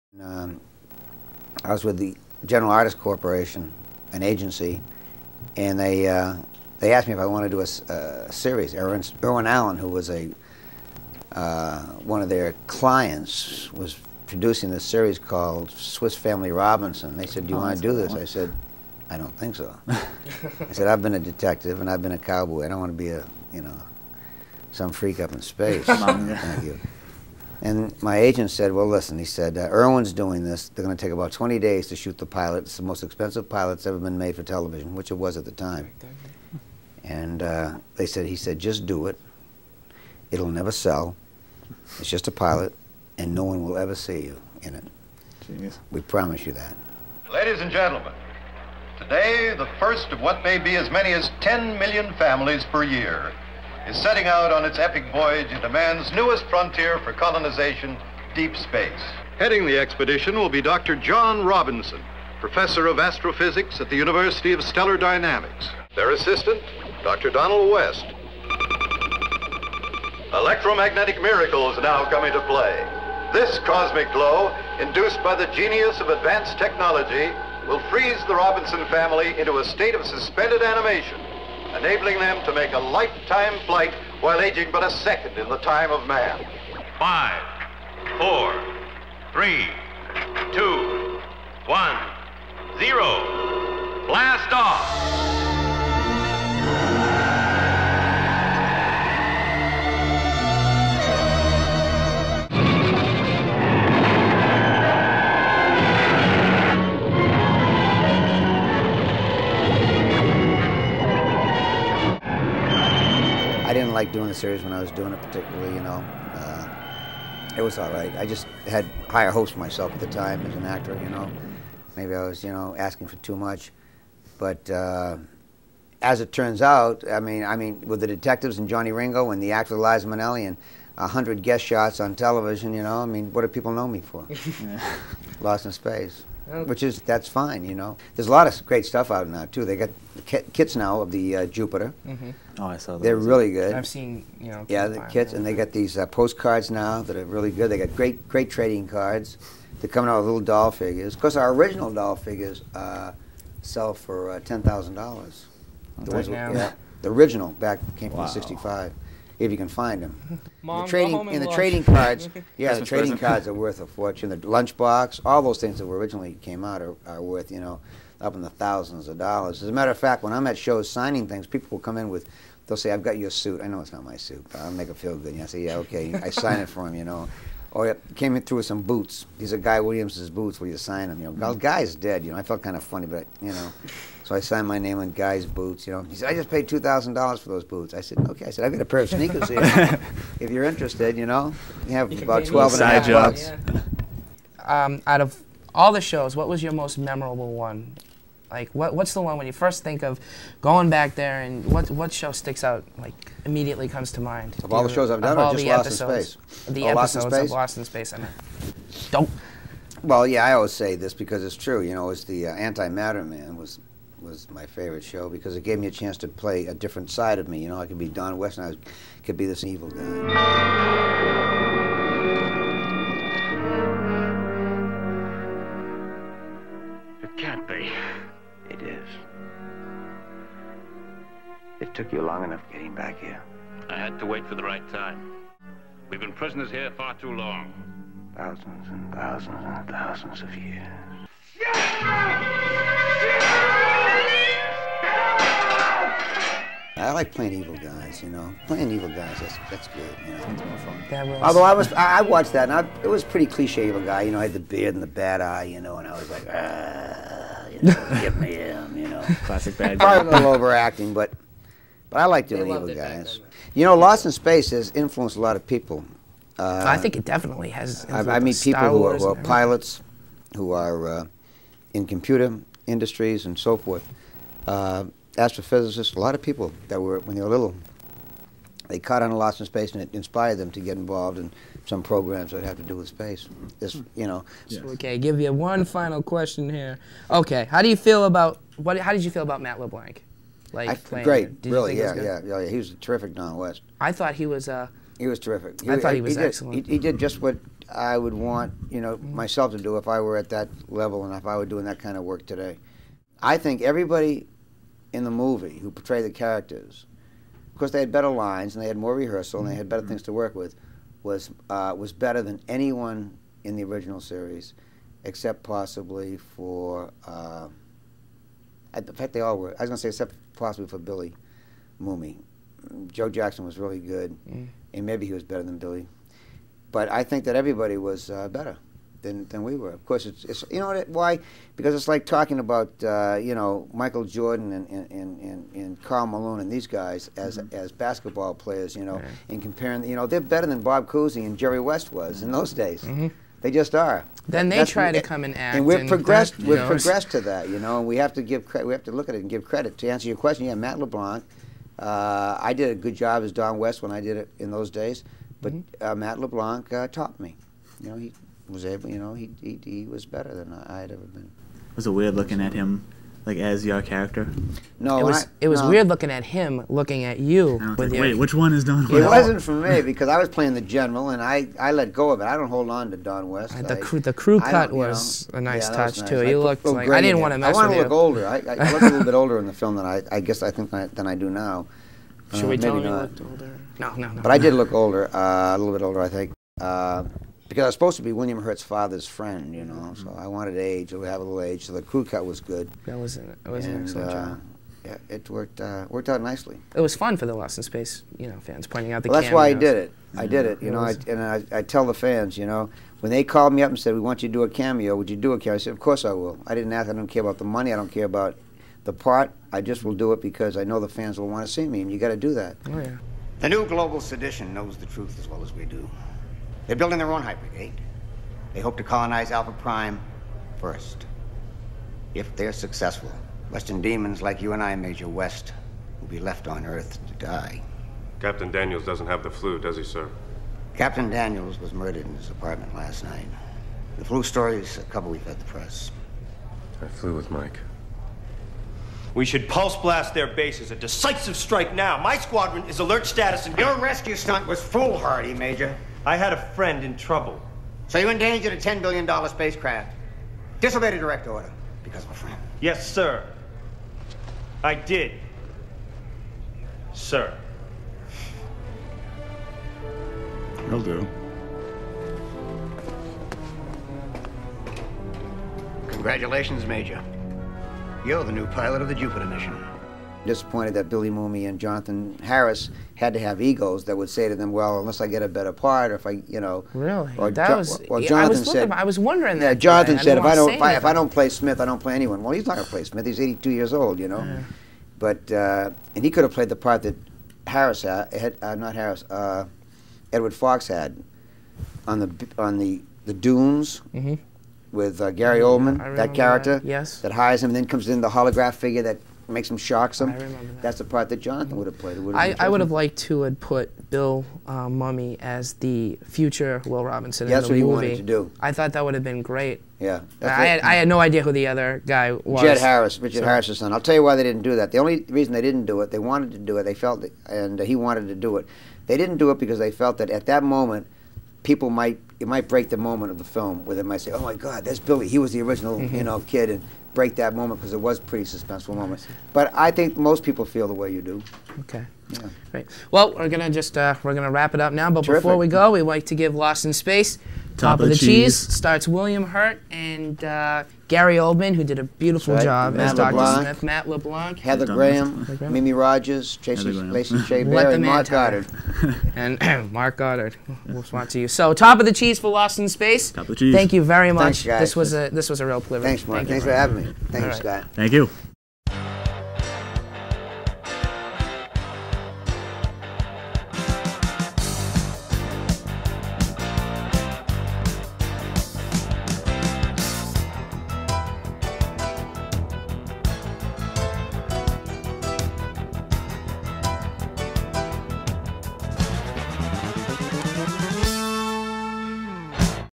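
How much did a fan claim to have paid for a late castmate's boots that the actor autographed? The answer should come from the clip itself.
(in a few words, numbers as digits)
$2,000.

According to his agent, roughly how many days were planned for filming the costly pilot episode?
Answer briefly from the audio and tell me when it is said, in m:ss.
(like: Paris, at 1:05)
20, at 0:31.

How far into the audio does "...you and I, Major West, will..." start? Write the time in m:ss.
7:04.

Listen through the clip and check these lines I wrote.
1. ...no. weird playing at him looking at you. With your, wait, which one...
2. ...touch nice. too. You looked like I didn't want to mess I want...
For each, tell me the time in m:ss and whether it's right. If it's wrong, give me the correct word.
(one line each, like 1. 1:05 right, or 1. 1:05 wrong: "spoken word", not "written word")
1. 6:05 wrong: "looking", not "playing"
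2. 6:15 right.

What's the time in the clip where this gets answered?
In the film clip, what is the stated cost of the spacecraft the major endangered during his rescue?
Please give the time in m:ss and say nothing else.
7:28.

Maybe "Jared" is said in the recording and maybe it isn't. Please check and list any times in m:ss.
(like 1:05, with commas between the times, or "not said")
8:32.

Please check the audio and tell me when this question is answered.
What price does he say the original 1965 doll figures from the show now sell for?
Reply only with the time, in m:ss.
2:34.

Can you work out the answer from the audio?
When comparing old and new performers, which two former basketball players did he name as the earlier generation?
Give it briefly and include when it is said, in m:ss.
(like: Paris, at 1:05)
Bob Cousy and Jerry West, at 5:40.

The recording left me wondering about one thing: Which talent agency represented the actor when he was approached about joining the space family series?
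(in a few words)
General Artists Corporation.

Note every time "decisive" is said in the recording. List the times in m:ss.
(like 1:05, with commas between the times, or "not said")
7:20.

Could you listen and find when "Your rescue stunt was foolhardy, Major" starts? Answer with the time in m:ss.
7:23.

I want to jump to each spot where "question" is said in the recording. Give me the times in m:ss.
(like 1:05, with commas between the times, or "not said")
4:46, 5:50.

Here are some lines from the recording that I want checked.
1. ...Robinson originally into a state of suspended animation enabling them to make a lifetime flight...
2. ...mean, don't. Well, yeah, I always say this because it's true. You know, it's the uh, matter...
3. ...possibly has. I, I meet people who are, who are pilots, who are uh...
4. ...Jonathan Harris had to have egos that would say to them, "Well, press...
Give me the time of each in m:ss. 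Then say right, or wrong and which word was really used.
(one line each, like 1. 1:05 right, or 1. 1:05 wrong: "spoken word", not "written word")
1. 1:18 wrong: "family", not "originally"
2. 3:28 right
3. 4:27 wrong: "definitely", not "possibly"
4. 7:51 wrong: "unless", not "press".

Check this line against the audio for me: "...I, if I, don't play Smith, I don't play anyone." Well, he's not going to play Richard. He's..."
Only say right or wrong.
wrong.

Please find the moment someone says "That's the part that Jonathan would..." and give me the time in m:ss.
8:20.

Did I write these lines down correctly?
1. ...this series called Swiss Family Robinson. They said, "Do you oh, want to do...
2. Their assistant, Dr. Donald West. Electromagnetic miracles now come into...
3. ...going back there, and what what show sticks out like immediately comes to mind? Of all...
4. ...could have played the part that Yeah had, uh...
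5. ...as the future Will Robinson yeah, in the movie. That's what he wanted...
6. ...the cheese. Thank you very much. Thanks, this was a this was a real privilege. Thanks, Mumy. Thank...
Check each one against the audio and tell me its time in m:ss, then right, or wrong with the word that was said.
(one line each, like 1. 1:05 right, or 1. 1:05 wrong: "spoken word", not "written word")
1. 0:14 right
2. 1:05 right
3. 3:20 right
4. 8:06 wrong: "Harris", not "Yeah"
5. 8:25 right
6. 9:13 wrong: "Mark", not "Mumy".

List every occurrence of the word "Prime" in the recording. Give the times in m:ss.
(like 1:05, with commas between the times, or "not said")
6:59.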